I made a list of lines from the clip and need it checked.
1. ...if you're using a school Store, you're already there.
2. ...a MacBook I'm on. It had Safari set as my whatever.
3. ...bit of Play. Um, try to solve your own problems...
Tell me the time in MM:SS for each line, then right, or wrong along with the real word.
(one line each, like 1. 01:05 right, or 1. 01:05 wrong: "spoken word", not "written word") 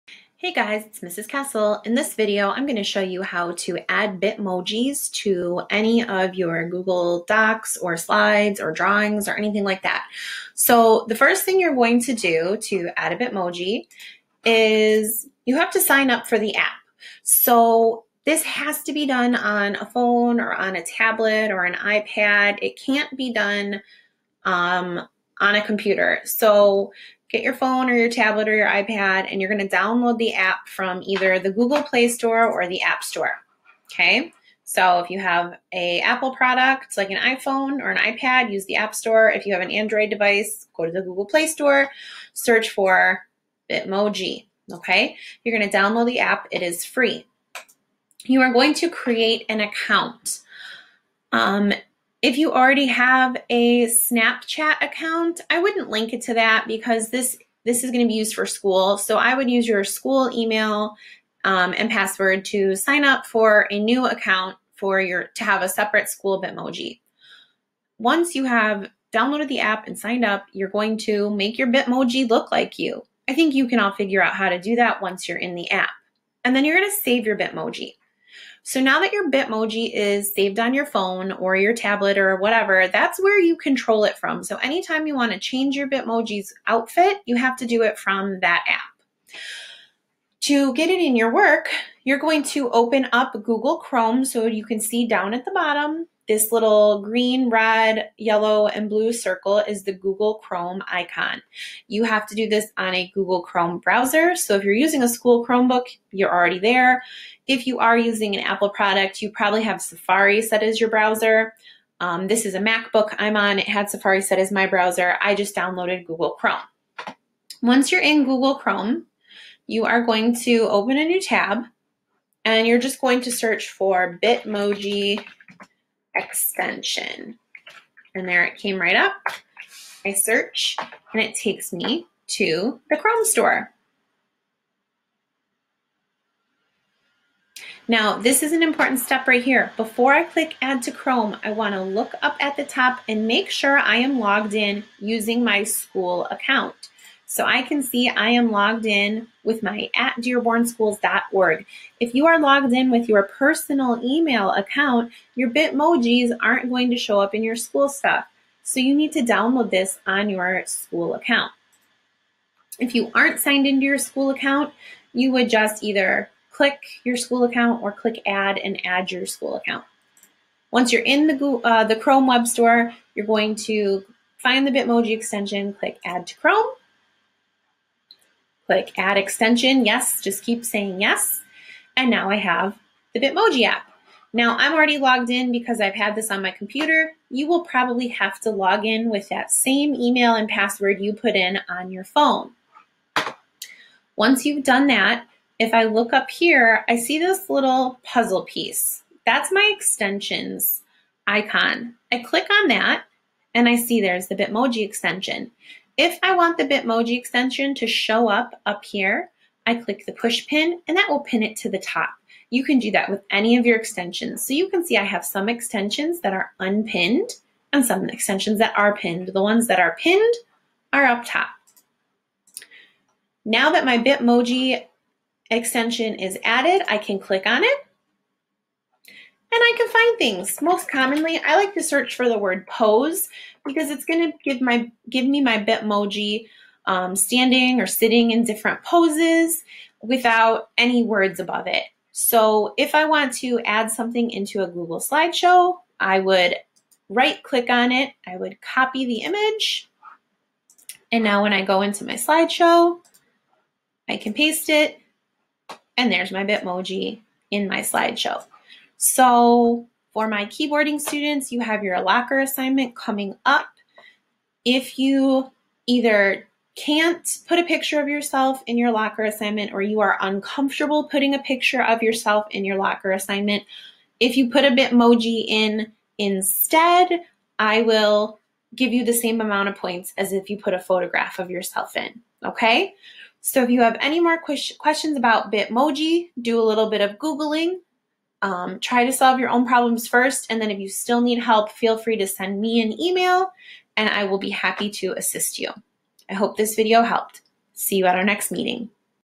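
1. 01:44 wrong: "Chromebook", not "Store"
2. 01:52 wrong: "browser", not "whatever"
3. 04:46 wrong: "Googling", not "Play".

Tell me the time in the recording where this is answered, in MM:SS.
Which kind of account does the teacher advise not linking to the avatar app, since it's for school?
00:53.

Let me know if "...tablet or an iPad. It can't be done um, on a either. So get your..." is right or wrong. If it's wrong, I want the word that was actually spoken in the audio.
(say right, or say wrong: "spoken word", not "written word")
wrong: "computer", not "either".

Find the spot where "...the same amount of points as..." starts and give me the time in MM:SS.
04:39.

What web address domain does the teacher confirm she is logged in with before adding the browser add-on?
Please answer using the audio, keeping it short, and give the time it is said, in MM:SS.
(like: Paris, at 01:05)
dearbornschools.org, at 02:30.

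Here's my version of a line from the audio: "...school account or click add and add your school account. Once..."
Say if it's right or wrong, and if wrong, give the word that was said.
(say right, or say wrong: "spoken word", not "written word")
right.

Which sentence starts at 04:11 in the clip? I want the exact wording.
And now when I go into my slideshow, I can paste it.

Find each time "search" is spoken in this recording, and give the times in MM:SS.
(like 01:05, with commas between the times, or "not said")
00:42, 02:03, 02:10, 03:51.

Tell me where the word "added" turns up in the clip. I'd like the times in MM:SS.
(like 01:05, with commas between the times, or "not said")
03:46.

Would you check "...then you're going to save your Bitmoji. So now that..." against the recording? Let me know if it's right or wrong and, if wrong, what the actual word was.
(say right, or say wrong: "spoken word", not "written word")
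right.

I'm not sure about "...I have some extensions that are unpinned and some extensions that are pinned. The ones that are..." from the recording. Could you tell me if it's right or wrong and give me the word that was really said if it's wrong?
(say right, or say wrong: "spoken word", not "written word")
right.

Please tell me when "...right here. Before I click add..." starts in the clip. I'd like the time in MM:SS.
02:19.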